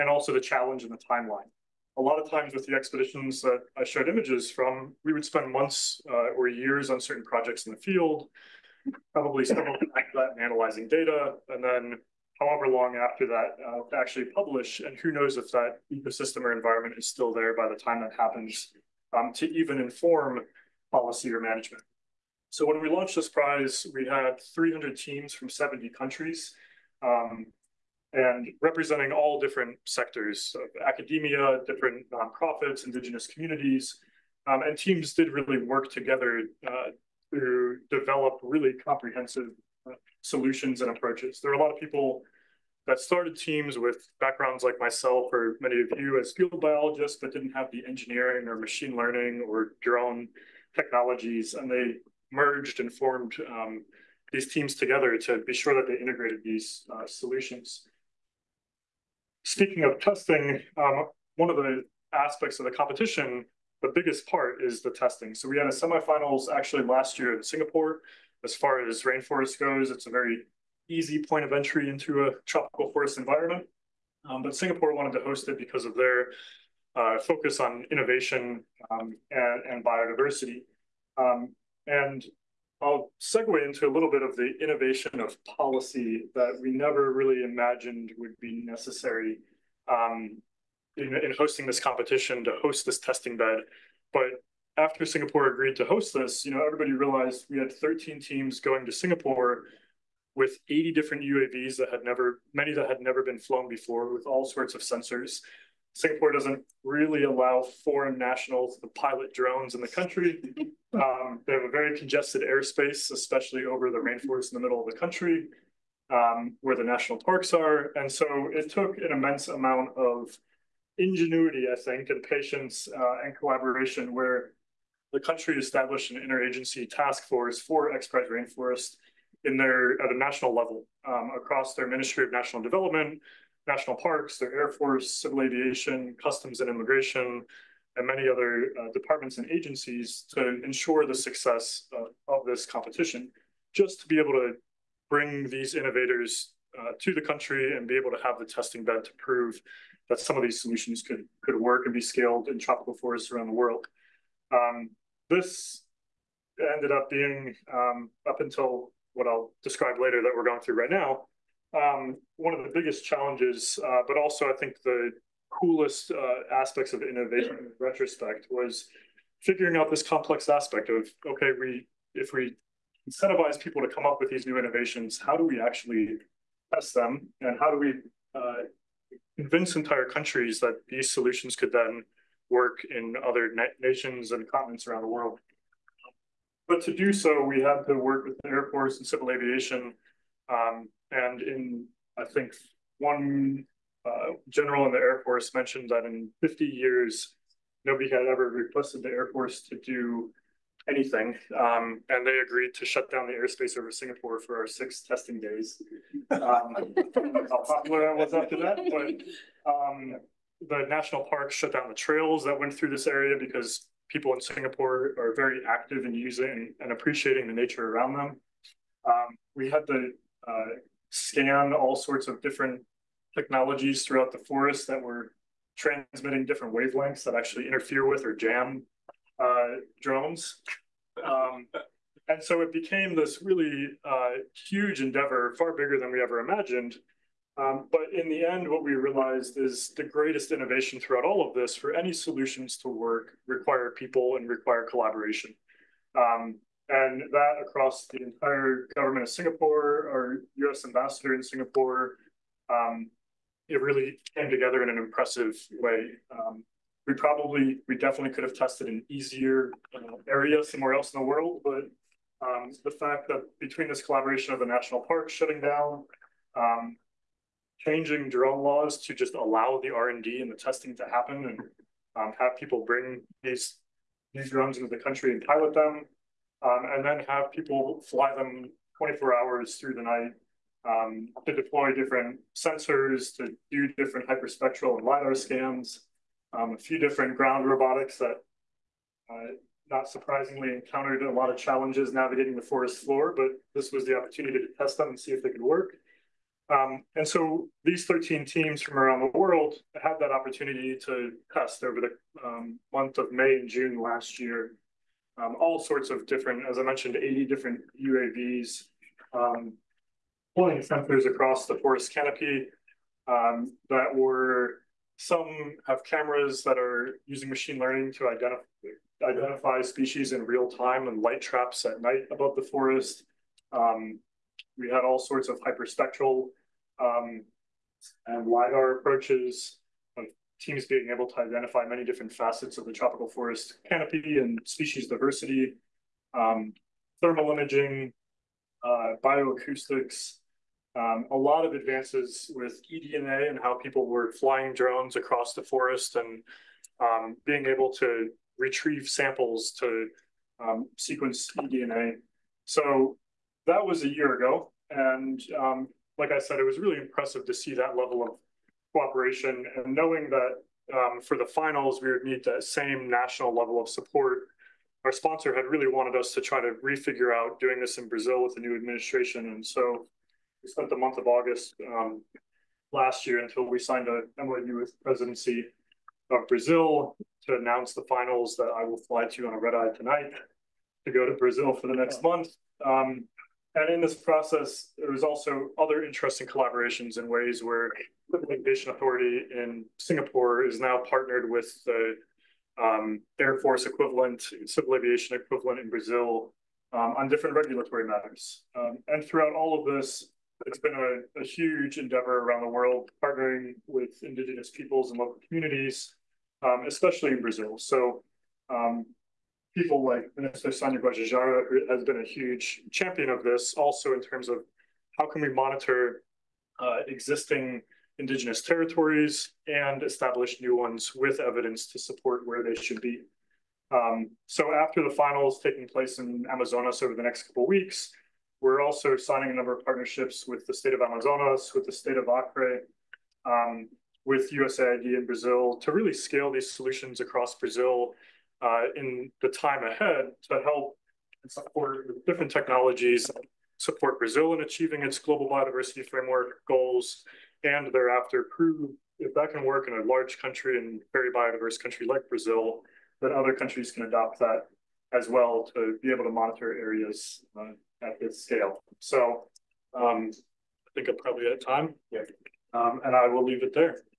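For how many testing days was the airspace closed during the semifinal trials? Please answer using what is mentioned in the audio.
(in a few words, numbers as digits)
6.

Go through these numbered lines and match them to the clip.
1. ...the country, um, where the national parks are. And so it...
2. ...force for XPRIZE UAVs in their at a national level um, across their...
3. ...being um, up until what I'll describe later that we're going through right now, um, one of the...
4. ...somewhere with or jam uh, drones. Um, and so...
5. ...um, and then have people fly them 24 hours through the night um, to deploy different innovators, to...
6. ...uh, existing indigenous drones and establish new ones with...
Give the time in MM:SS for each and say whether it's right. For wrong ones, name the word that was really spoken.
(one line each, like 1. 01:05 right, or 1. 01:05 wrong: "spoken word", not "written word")
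1. 01:54 right
2. 02:07 wrong: "Rainforest", not "UAVs"
3. 02:37 right
4. 03:47 wrong: "interfere", not "somewhere"
5. 04:36 wrong: "sensors", not "innovators"
6. 06:56 wrong: "territories", not "drones".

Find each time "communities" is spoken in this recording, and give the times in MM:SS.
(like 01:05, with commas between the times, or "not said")
00:33, 06:45.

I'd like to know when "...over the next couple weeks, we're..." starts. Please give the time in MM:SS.
07:07.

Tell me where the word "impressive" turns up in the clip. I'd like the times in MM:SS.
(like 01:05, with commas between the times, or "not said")
04:14, 05:56.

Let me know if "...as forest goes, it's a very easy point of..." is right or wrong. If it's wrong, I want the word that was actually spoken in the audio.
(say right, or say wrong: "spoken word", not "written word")
wrong: "rainforest", not "forest".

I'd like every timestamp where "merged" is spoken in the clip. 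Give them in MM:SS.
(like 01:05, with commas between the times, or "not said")
00:52.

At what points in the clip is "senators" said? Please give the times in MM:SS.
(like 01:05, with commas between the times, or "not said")
not said.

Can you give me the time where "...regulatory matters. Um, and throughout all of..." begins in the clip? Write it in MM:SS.
06:37.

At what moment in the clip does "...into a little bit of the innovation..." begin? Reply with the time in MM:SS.
01:23.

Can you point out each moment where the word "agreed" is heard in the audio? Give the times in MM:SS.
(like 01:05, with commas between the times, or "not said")
01:35, 03:22.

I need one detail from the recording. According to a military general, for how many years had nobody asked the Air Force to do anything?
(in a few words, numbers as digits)
50 years.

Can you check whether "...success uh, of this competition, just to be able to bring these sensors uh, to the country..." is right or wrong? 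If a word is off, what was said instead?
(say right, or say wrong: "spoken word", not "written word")
wrong: "innovators", not "sensors".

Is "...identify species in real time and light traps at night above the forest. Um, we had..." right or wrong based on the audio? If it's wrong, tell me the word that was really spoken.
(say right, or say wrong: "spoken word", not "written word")
right.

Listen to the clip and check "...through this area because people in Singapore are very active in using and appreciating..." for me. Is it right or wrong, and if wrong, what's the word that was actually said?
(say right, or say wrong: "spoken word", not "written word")
right.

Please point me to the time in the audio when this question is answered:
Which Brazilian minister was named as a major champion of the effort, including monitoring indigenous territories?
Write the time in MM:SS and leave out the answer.
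06:50.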